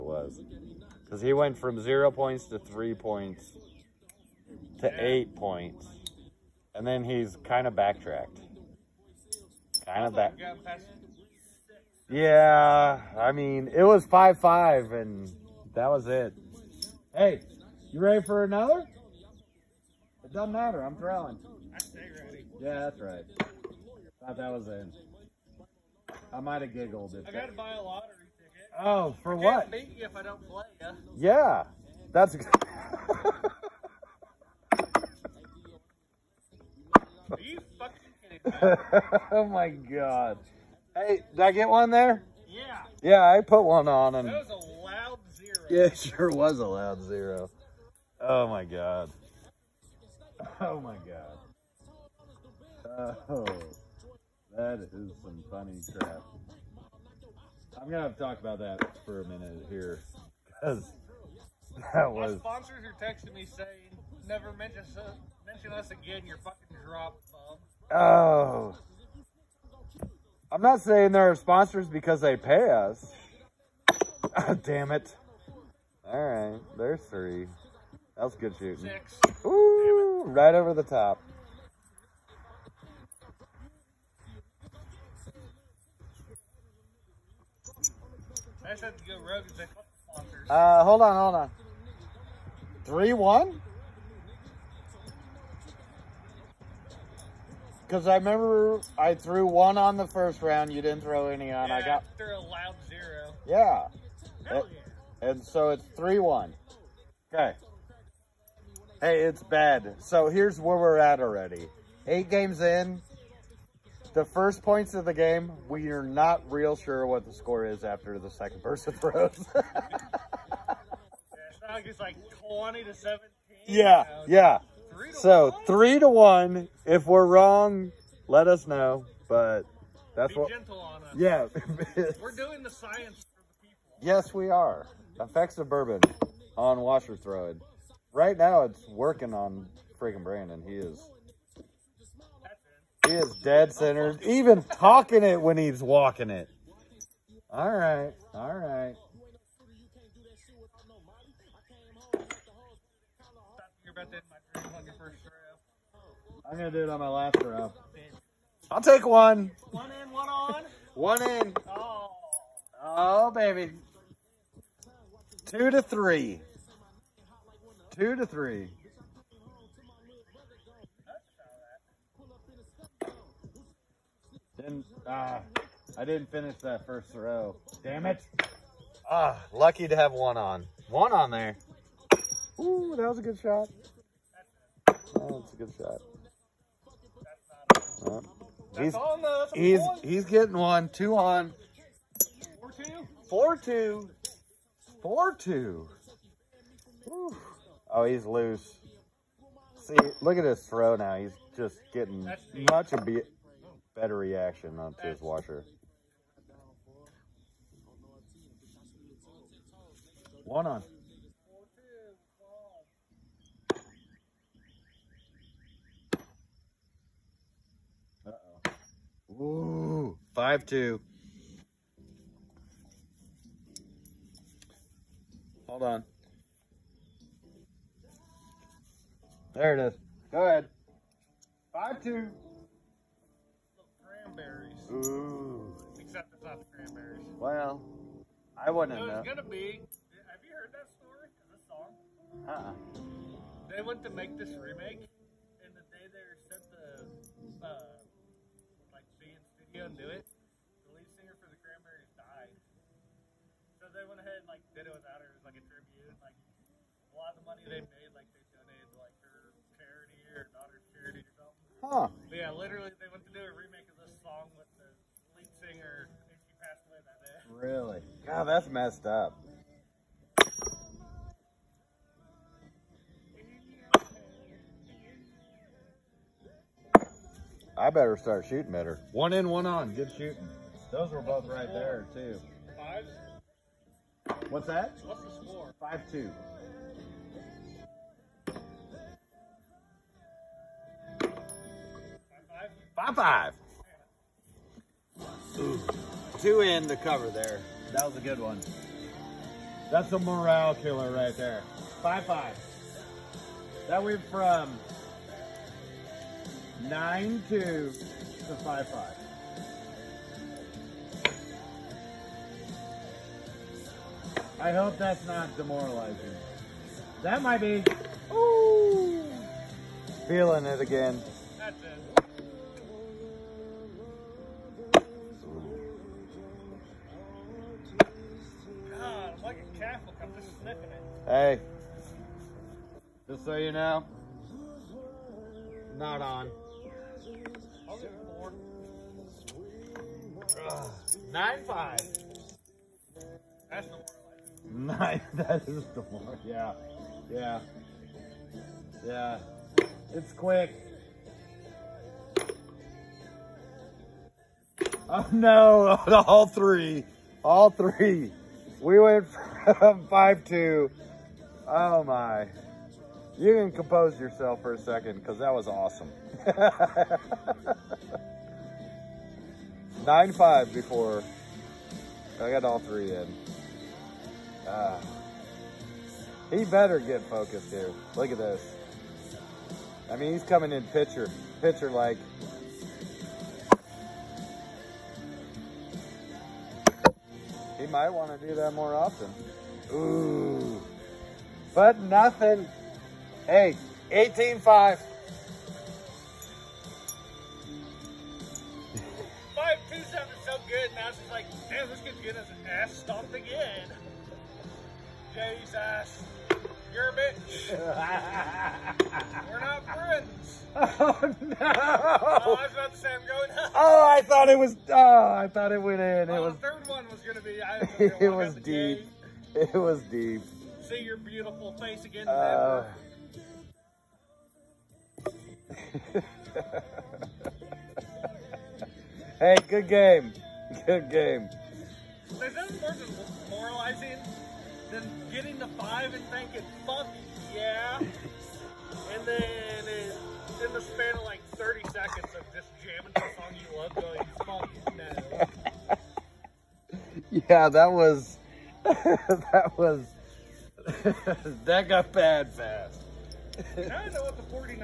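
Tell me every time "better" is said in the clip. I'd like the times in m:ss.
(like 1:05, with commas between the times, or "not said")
3:23, 4:37, 6:16.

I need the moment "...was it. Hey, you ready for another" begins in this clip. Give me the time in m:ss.
0:15.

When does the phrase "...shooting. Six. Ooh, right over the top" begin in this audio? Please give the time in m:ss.
1:18.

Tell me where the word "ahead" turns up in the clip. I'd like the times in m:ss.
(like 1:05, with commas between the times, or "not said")
3:50, 4:14.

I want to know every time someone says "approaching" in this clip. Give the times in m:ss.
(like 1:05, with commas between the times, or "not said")
not said.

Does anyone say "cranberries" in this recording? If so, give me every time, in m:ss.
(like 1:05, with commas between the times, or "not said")
3:56, 4:11.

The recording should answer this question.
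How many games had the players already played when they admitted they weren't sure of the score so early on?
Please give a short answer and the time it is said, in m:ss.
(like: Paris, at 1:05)
8, at 1:52.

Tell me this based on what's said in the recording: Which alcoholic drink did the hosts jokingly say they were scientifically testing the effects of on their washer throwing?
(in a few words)
bourbon.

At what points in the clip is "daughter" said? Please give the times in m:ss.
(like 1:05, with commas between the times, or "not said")
4:20.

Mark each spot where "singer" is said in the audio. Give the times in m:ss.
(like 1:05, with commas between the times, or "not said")
4:11, 4:25.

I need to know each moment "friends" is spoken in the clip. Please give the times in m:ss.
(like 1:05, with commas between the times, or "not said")
6:49.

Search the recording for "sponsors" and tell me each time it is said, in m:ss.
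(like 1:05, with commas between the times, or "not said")
1:02, 1:11, 1:30.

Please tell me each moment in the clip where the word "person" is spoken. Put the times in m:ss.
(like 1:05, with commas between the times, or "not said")
1:58.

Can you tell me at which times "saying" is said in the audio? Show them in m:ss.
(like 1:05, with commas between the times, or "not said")
1:03, 1:10.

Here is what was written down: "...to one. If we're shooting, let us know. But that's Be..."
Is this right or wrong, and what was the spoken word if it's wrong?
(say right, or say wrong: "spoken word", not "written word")
wrong: "wrong", not "shooting".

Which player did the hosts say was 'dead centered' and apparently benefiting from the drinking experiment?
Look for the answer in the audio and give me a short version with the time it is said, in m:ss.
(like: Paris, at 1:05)
Brandon, at 2:20.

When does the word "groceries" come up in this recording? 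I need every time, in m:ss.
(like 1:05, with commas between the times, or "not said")
not said.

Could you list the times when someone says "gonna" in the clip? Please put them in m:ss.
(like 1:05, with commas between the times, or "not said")
0:57, 3:59, 6:57.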